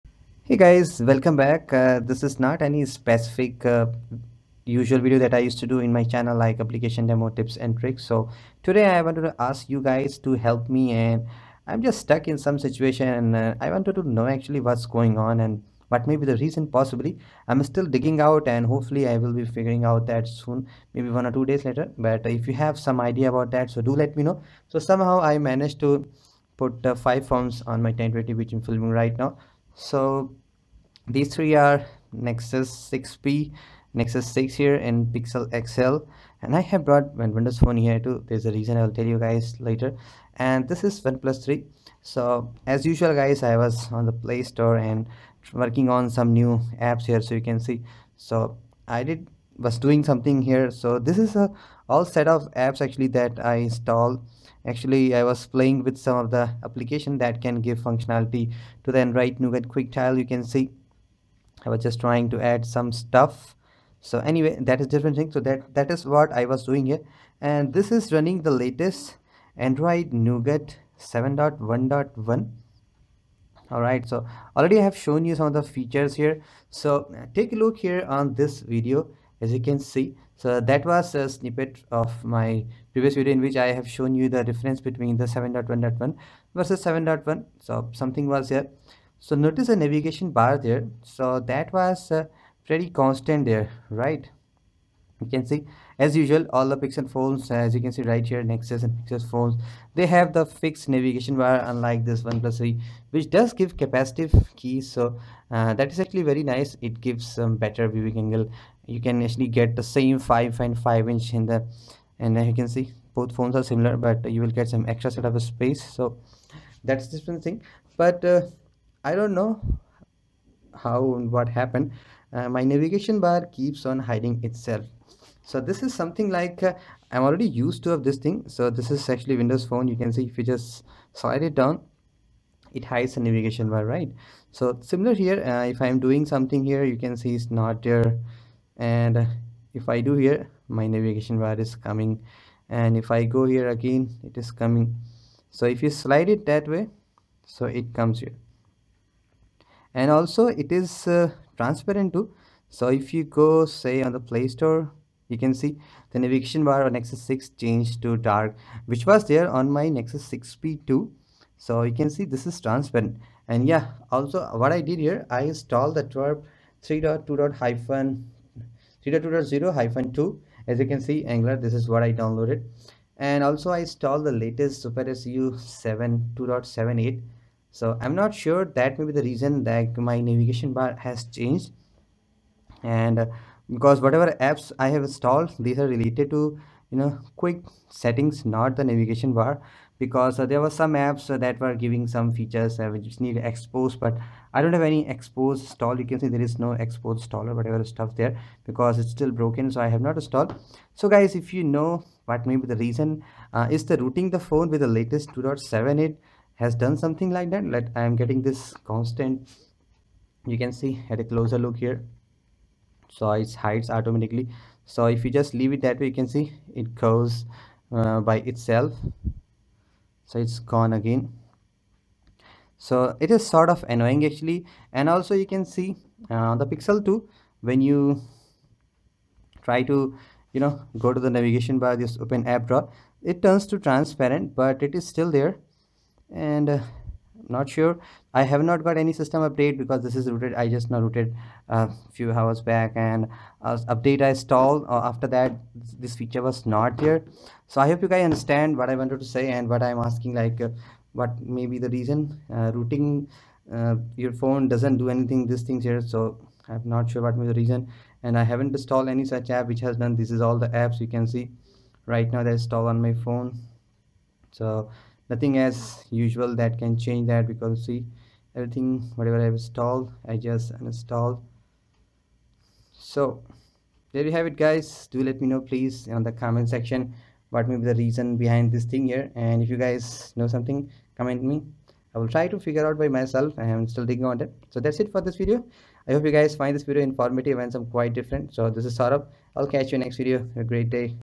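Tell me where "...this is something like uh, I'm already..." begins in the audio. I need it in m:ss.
2:05.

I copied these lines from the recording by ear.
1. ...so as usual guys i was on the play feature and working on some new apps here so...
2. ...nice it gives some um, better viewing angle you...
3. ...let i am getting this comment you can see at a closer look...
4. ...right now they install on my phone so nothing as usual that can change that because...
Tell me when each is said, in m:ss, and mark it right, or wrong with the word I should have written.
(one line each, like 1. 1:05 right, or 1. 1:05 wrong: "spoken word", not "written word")
1. 0:42 wrong: "store", not "feature"
2. 1:46 right
3. 3:27 wrong: "constant", not "comment"
4. 4:22 right.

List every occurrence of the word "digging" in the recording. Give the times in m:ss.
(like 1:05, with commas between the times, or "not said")
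0:17, 4:44.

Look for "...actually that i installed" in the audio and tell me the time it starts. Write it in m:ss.
0:52.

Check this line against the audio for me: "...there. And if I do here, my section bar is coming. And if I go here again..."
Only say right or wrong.
wrong.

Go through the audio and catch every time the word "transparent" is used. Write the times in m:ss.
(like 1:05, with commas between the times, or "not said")
2:31, 2:42, 3:53.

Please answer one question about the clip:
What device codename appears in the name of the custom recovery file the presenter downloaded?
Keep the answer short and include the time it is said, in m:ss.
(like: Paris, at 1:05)
angler, at 2:51.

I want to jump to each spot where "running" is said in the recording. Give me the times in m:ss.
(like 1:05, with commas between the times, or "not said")
1:08.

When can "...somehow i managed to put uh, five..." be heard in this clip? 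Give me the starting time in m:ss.
0:24.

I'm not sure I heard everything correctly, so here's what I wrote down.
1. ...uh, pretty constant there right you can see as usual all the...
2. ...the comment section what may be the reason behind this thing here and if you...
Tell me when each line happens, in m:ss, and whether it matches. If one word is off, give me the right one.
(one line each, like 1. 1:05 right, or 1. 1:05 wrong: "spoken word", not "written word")
1. 1:32 right
2. 4:36 right.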